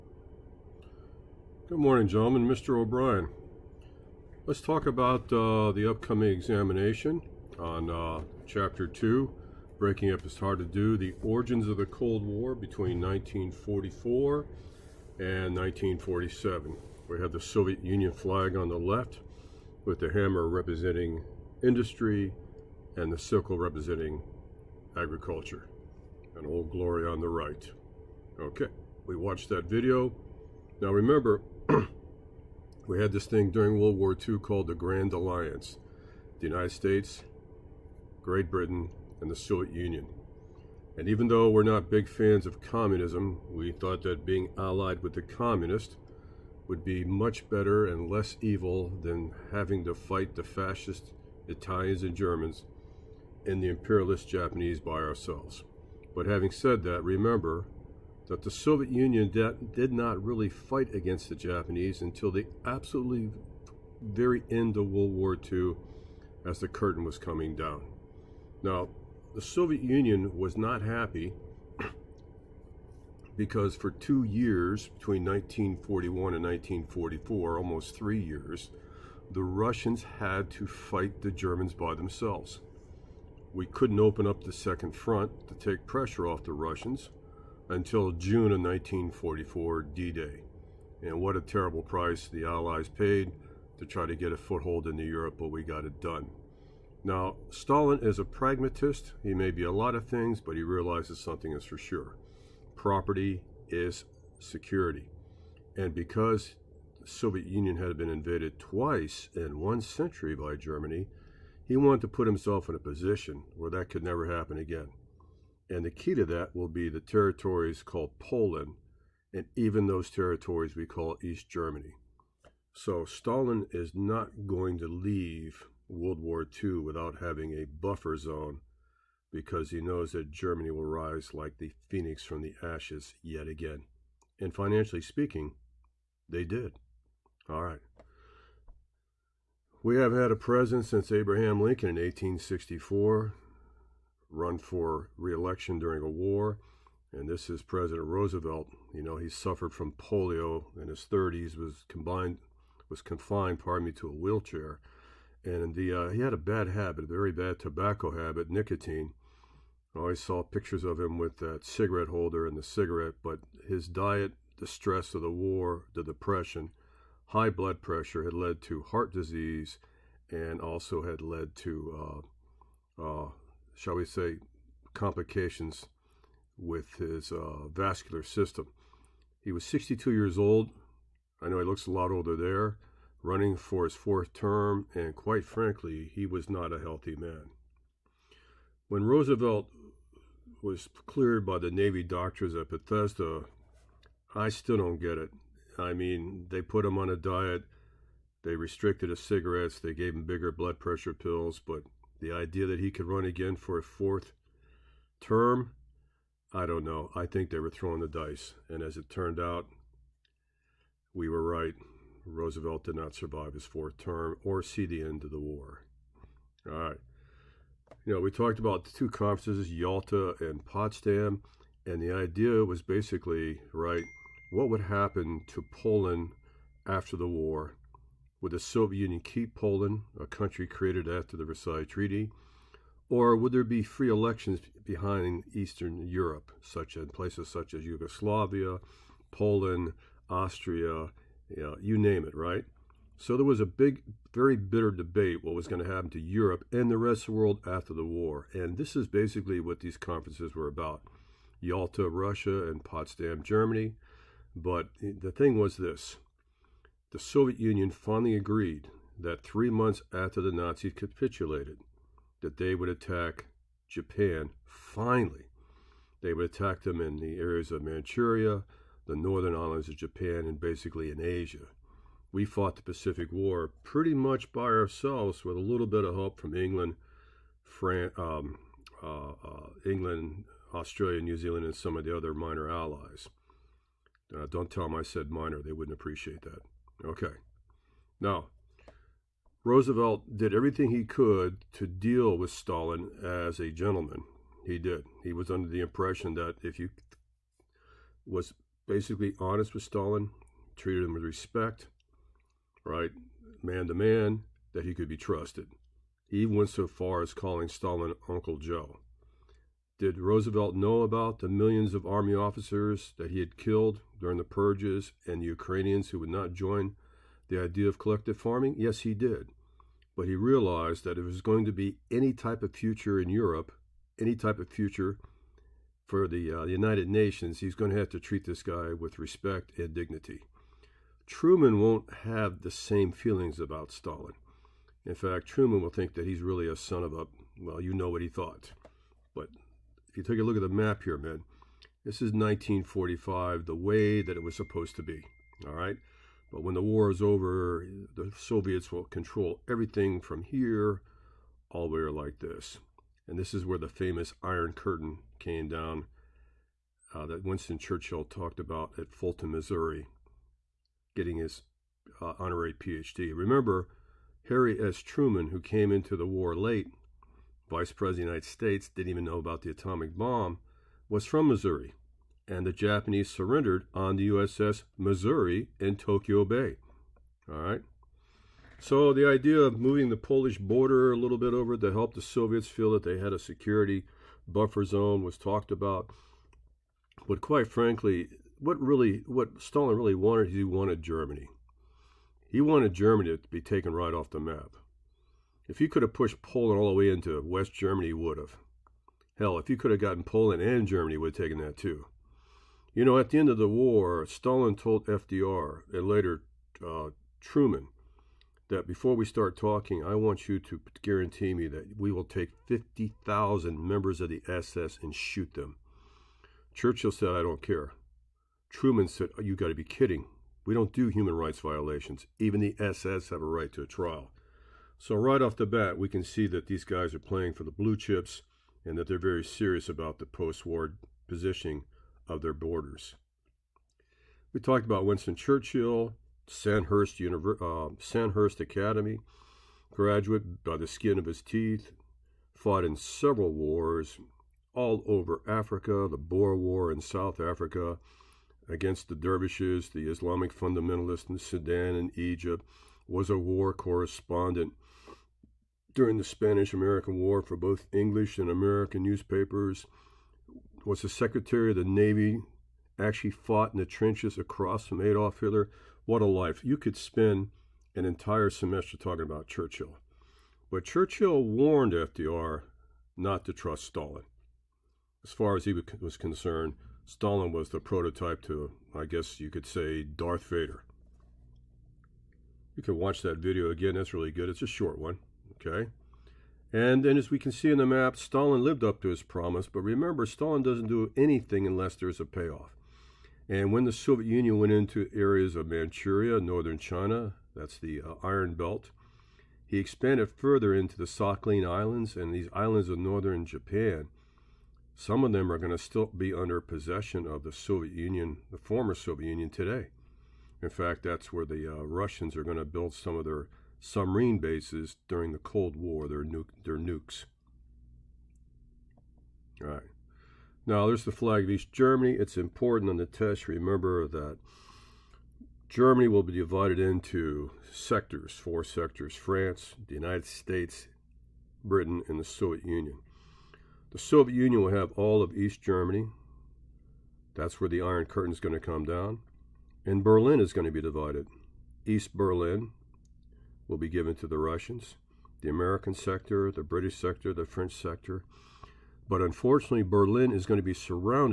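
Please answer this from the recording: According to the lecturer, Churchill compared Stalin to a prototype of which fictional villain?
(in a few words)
Darth Vader.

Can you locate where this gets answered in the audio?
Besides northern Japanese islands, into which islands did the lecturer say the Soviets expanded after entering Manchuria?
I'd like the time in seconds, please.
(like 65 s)
501 s.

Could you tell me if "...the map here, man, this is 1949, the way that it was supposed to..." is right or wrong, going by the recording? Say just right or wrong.
wrong.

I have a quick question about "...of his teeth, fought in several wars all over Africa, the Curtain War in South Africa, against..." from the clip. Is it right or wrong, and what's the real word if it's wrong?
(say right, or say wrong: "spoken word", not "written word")
wrong: "Boer", not "Curtain".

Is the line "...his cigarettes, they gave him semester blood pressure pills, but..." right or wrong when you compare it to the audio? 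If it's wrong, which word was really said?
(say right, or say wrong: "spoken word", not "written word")
wrong: "bigger", not "semester".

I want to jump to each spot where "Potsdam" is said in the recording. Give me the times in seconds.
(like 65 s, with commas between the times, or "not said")
220 s, 252 s.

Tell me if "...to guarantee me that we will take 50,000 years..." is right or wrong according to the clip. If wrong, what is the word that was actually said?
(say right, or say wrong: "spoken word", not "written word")
wrong: "members", not "years".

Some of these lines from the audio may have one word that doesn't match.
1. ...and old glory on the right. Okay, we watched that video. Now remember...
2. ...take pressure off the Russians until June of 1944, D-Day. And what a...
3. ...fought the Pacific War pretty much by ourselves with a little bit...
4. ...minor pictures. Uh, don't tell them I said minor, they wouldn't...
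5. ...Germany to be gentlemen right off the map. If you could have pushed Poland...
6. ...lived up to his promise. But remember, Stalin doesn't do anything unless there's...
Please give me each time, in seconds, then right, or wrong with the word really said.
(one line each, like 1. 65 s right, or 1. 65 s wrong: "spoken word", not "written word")
1. 26 s right
2. 85 s right
3. 272 s right
4. 282 s wrong: "allies", not "pictures"
5. 392 s wrong: "taken", not "gentlemen"
6. 488 s right.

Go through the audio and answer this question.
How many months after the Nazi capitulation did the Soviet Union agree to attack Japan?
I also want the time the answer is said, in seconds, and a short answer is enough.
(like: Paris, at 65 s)
3, at 259 s.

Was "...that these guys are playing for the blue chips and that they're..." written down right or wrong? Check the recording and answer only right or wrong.
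right.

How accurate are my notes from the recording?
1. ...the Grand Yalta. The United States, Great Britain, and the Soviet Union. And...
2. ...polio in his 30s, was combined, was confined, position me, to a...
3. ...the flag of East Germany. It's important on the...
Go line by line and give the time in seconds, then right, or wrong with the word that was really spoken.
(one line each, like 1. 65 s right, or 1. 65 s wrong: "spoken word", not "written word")
1. 34 s wrong: "Alliance", not "Yalta"
2. 149 s wrong: "pardon", not "position"
3. 521 s right.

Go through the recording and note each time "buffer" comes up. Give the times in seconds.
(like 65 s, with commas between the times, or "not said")
127 s, 384 s.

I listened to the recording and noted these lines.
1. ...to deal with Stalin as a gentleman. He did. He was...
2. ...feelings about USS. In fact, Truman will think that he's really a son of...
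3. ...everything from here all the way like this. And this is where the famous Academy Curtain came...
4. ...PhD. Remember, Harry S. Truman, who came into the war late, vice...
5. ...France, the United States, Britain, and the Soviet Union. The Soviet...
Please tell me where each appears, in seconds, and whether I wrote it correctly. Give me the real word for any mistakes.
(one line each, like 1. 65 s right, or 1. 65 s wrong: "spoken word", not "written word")
1. 291 s right
2. 333 s wrong: "Stalin", not "USS"
3. 349 s wrong: "Iron", not "Academy"
4. 362 s right
5. 529 s right.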